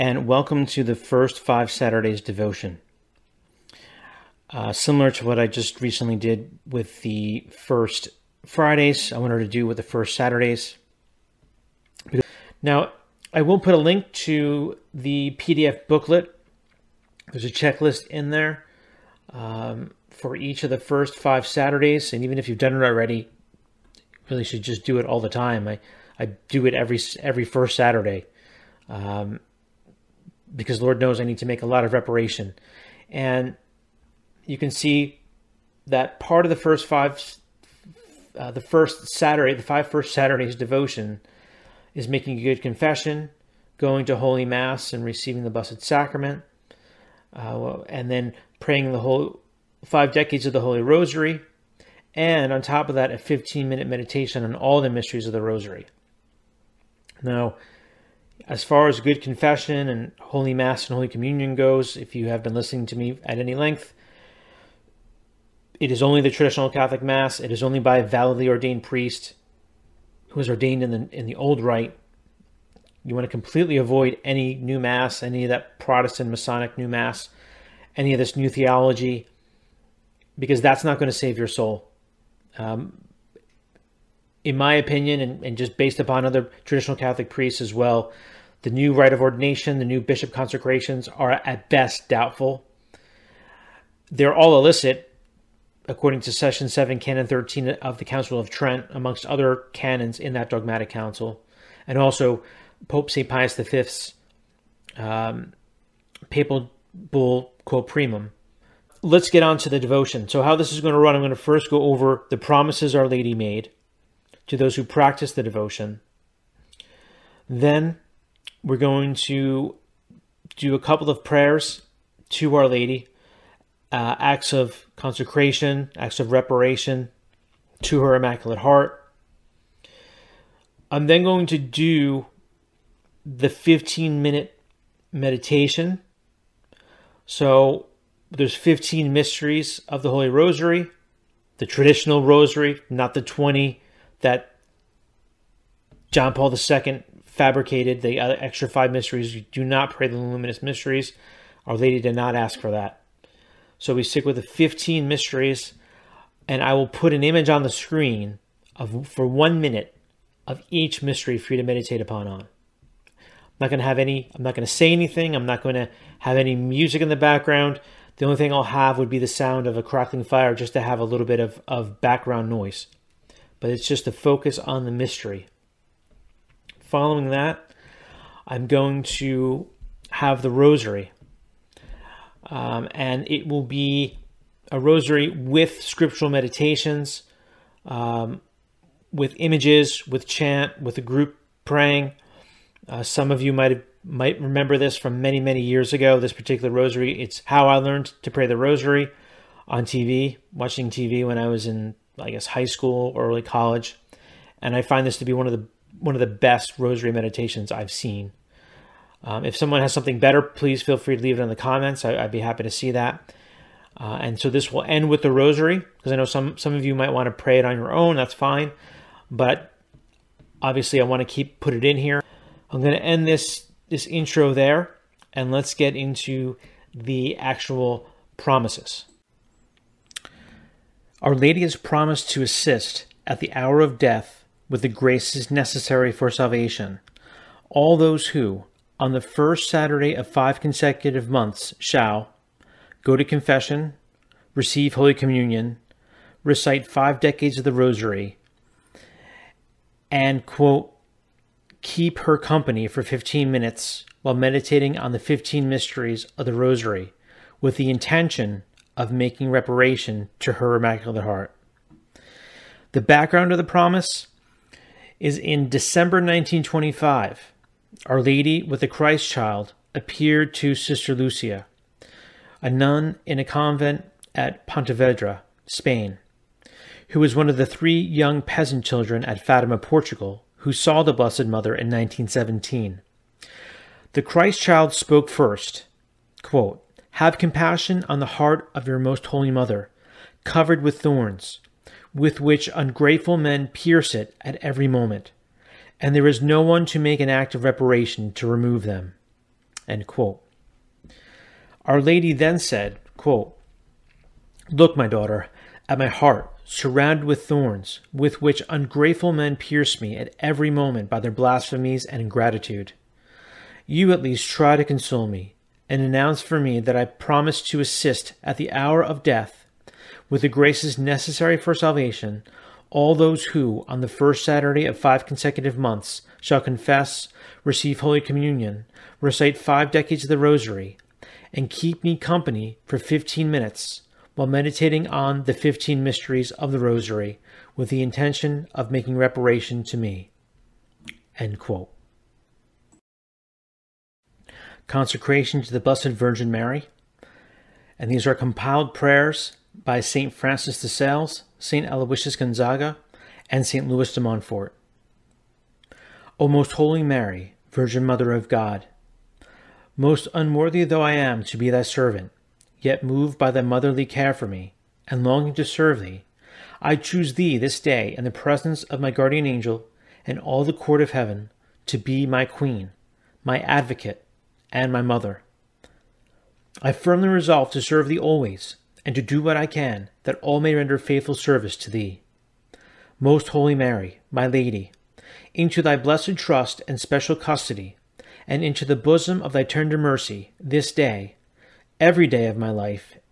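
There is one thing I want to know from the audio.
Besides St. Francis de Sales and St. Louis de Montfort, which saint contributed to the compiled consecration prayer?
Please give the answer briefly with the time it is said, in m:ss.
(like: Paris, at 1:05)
St. Aloysius Gonzaga, at 5:51.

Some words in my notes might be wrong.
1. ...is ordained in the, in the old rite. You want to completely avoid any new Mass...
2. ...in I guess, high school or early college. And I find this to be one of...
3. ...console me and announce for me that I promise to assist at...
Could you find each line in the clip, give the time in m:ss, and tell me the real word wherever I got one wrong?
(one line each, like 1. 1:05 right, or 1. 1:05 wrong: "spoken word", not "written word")
1. 1:10 right
2. 3:21 right
3. 5:14 right.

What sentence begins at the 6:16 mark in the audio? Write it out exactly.
I firmly resolve to serve thee always, and to do what I can, that all may render faithful service to thee.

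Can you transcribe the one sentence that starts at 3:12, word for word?
Uh, some of you might might remember this from many many years ago.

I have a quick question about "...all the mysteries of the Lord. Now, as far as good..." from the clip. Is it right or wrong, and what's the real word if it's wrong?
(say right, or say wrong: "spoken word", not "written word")
wrong: "Rosary", not "Lord".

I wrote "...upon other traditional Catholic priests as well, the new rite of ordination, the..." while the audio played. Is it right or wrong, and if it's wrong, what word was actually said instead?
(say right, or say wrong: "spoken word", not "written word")
right.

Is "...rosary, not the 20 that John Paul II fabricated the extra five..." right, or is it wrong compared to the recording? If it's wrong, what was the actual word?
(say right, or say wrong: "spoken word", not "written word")
right.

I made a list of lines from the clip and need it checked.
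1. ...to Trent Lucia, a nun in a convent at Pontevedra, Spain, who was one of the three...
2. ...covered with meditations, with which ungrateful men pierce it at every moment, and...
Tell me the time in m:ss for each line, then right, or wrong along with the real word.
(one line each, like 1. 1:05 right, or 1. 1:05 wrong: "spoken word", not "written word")
1. 4:30 wrong: "Sister", not "Trent"
2. 4:50 wrong: "thorns", not "meditations".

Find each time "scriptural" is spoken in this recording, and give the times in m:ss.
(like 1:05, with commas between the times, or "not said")
3:05.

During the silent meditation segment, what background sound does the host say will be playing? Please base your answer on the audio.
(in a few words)
Crackling fire.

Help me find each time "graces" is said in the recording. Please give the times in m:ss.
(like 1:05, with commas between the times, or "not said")
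3:54, 5:20.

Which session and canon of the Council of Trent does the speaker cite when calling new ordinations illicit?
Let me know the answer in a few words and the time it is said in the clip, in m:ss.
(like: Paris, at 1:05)
Session 7, Canon 13, at 1:36.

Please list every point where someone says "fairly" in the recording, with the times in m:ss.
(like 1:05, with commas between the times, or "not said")
not said.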